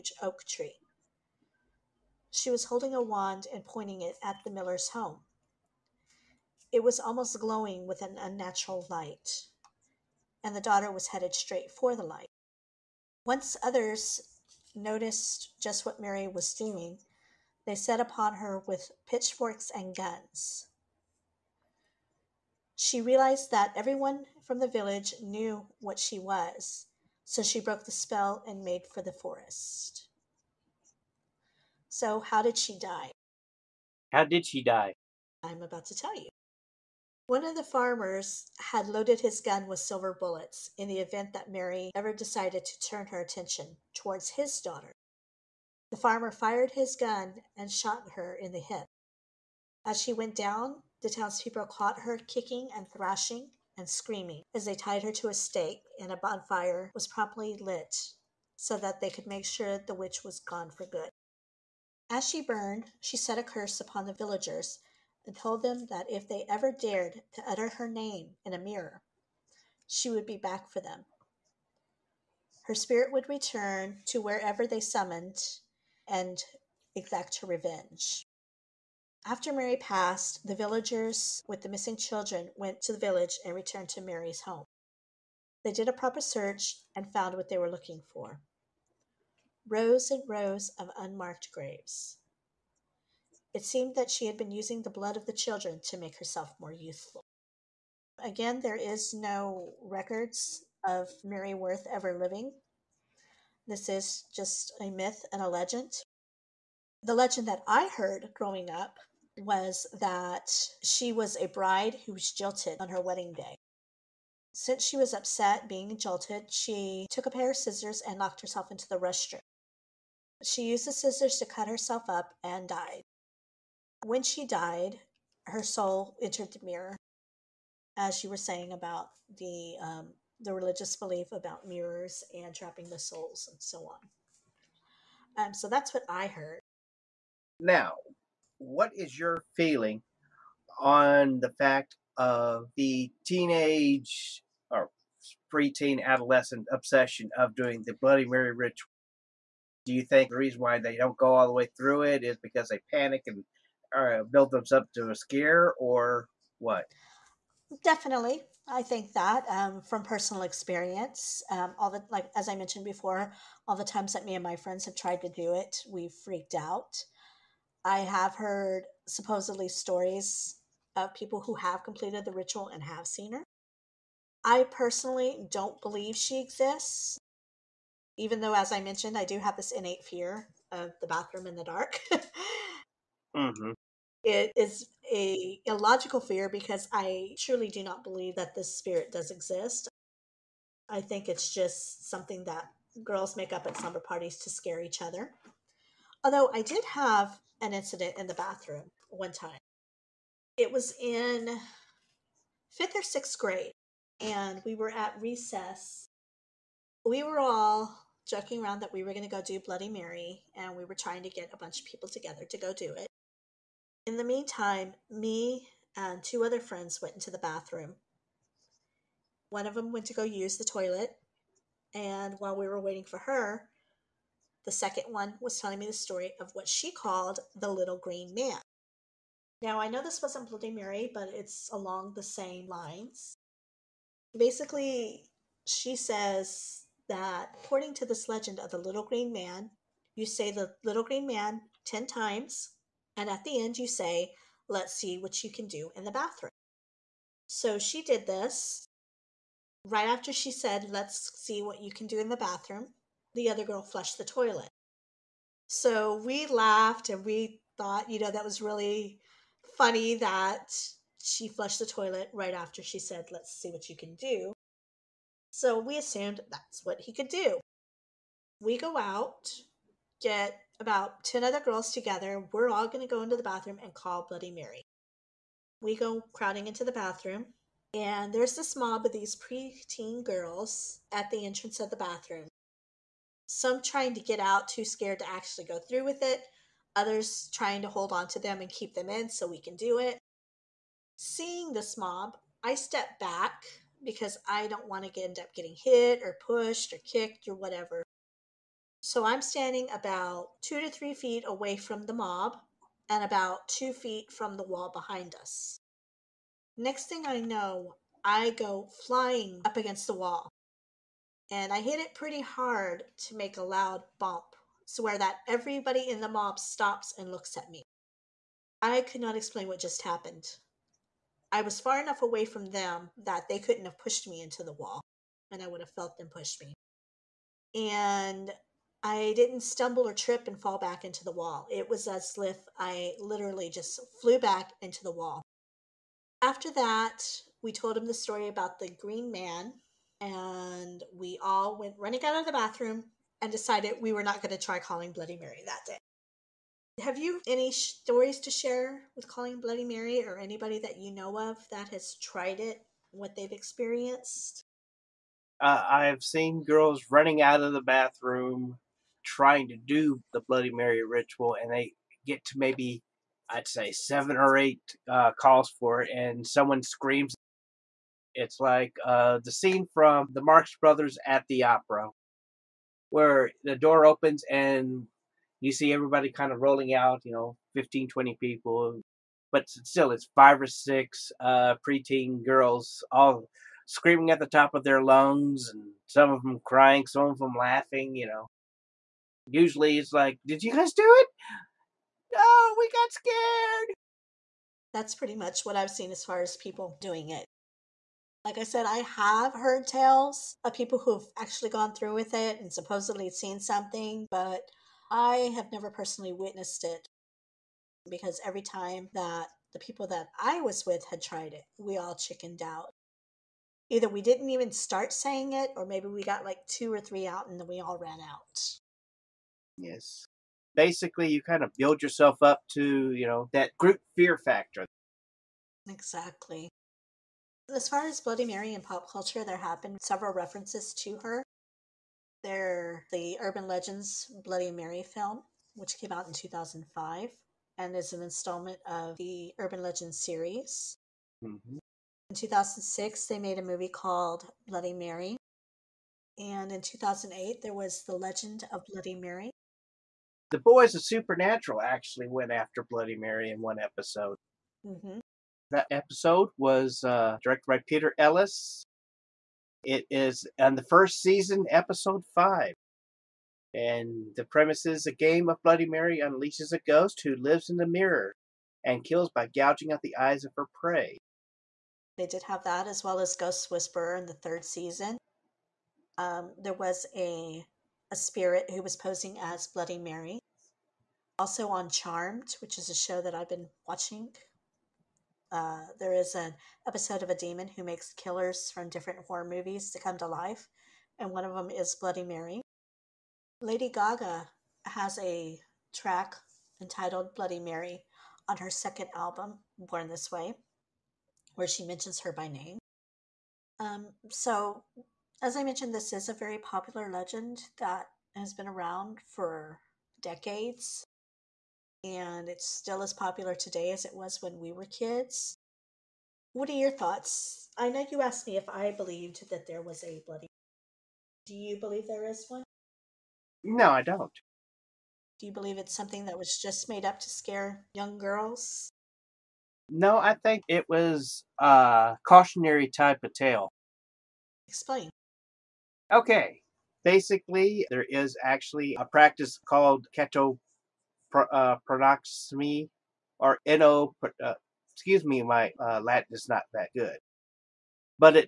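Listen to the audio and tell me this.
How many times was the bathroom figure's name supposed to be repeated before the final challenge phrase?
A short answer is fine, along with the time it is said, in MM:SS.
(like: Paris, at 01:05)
10, at 04:01.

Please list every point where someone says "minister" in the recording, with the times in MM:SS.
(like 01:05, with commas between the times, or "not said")
not said.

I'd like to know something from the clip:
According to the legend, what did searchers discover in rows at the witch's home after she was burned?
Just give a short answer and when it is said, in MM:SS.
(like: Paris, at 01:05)
Unmarked graves, at 01:30.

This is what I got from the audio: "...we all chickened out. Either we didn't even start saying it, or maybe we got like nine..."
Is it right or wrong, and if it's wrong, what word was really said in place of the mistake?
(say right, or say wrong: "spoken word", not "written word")
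wrong: "two", not "nine".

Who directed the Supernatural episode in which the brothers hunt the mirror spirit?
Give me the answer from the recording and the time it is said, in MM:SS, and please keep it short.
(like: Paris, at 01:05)
Peter Ellis, at 07:37.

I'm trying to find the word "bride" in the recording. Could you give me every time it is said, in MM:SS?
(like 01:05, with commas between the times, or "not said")
01:51.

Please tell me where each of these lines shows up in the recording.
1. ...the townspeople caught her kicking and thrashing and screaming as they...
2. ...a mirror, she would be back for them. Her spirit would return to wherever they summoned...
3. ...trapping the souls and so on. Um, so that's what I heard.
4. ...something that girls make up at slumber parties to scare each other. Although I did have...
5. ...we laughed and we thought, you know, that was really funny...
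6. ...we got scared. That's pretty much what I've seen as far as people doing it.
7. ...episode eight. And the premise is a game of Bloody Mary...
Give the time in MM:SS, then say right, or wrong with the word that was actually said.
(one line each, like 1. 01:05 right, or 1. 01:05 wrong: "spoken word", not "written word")
1. 00:51 right
2. 01:08 right
3. 02:12 right
4. 03:12 right
5. 04:16 right
6. 06:32 right
7. 07:41 wrong: "five", not "eight".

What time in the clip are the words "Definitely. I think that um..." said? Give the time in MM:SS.
02:37.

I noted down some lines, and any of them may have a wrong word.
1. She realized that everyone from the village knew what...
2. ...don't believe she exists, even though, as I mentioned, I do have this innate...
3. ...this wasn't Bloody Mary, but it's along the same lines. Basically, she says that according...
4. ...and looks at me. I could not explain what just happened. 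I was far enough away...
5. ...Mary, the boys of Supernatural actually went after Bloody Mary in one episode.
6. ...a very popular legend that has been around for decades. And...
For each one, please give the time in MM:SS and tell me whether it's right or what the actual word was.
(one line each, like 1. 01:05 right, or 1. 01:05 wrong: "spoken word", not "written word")
1. 00:22 right
2. 02:55 right
3. 03:50 right
4. 05:17 right
5. 07:29 right
6. 08:26 right.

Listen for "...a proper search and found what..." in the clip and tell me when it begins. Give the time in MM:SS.
01:25.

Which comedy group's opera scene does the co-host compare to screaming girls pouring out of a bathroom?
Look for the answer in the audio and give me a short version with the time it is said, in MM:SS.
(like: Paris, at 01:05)
The Marx Brothers, at 06:10.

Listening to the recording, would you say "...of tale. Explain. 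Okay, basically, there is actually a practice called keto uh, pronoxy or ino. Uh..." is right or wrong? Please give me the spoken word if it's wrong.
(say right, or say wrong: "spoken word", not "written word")
right.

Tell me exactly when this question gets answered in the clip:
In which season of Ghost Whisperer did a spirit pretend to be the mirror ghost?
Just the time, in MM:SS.
07:54.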